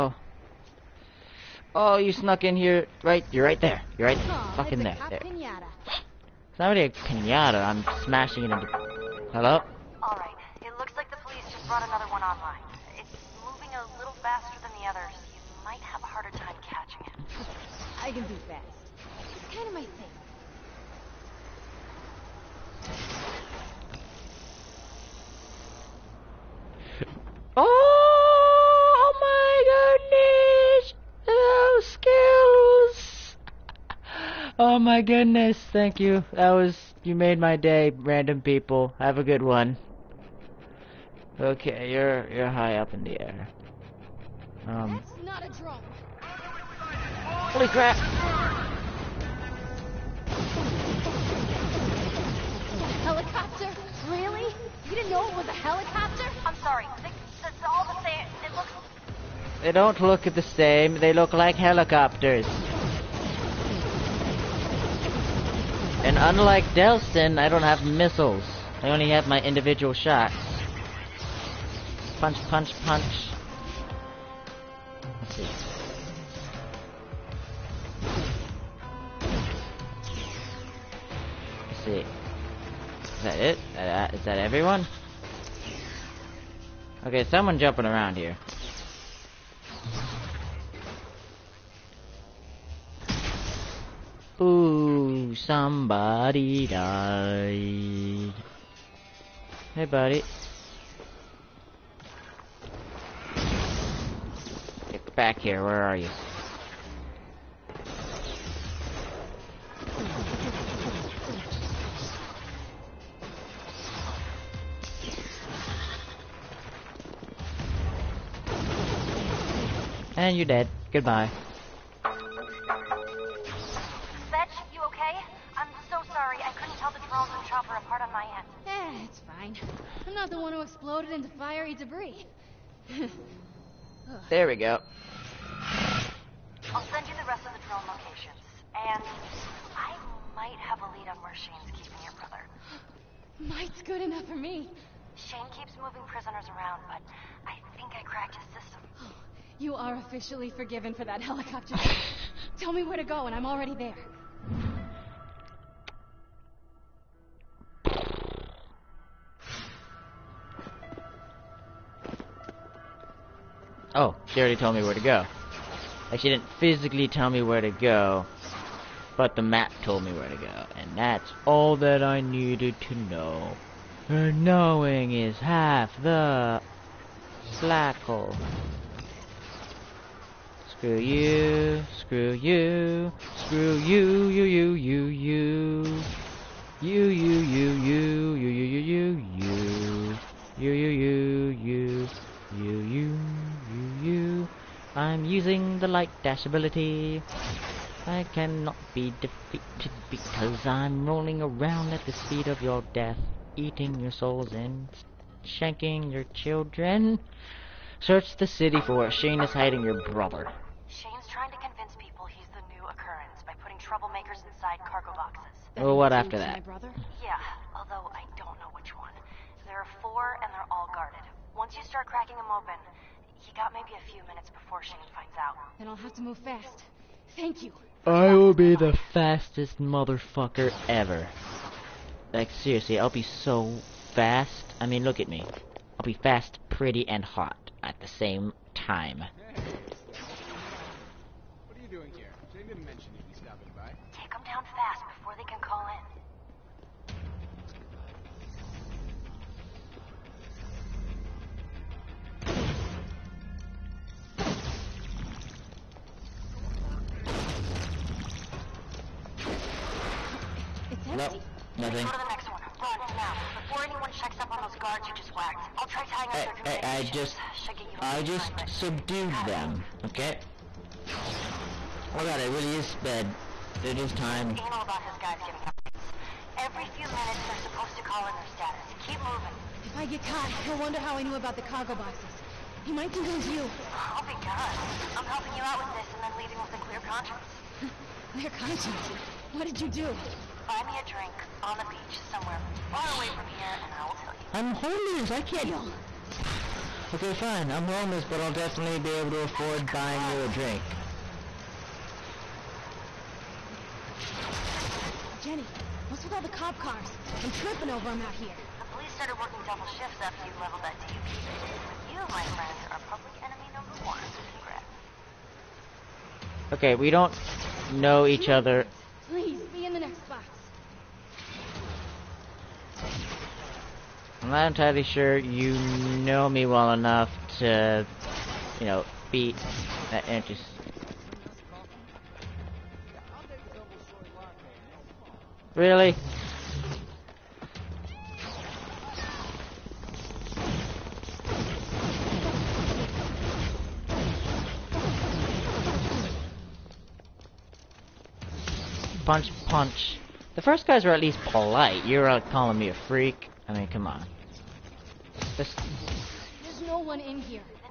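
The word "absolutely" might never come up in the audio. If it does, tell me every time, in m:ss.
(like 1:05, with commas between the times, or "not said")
not said.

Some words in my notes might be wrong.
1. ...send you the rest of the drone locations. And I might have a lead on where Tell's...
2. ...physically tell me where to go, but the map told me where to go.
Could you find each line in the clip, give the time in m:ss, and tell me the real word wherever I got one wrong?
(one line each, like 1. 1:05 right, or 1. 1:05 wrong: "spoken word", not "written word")
1. 2:16 wrong: "Shane", not "Tell"
2. 2:46 right.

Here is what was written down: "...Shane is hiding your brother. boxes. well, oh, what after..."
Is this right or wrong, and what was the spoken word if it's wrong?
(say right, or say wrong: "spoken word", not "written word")
right.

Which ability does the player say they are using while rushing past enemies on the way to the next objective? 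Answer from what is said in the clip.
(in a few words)
Light dash.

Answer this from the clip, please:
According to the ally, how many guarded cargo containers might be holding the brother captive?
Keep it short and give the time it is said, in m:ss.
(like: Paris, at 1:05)
4, at 3:40.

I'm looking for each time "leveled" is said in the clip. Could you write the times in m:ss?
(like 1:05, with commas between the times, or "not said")
5:10.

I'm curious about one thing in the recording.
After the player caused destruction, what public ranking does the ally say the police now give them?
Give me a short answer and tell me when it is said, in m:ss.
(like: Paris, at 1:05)
Public enemy number one, at 5:13.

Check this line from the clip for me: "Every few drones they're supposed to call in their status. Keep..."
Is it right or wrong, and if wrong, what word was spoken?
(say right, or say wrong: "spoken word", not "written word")
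wrong: "minutes", not "drones".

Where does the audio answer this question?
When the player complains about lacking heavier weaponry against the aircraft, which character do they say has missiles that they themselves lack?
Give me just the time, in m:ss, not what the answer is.
1:06.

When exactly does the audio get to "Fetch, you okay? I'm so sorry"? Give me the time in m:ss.
2:01.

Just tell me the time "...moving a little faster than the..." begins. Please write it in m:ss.
0:13.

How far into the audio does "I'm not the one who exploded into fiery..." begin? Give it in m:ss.
2:10.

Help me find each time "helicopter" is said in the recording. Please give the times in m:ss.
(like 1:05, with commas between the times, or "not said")
0:55, 1:01, 2:31.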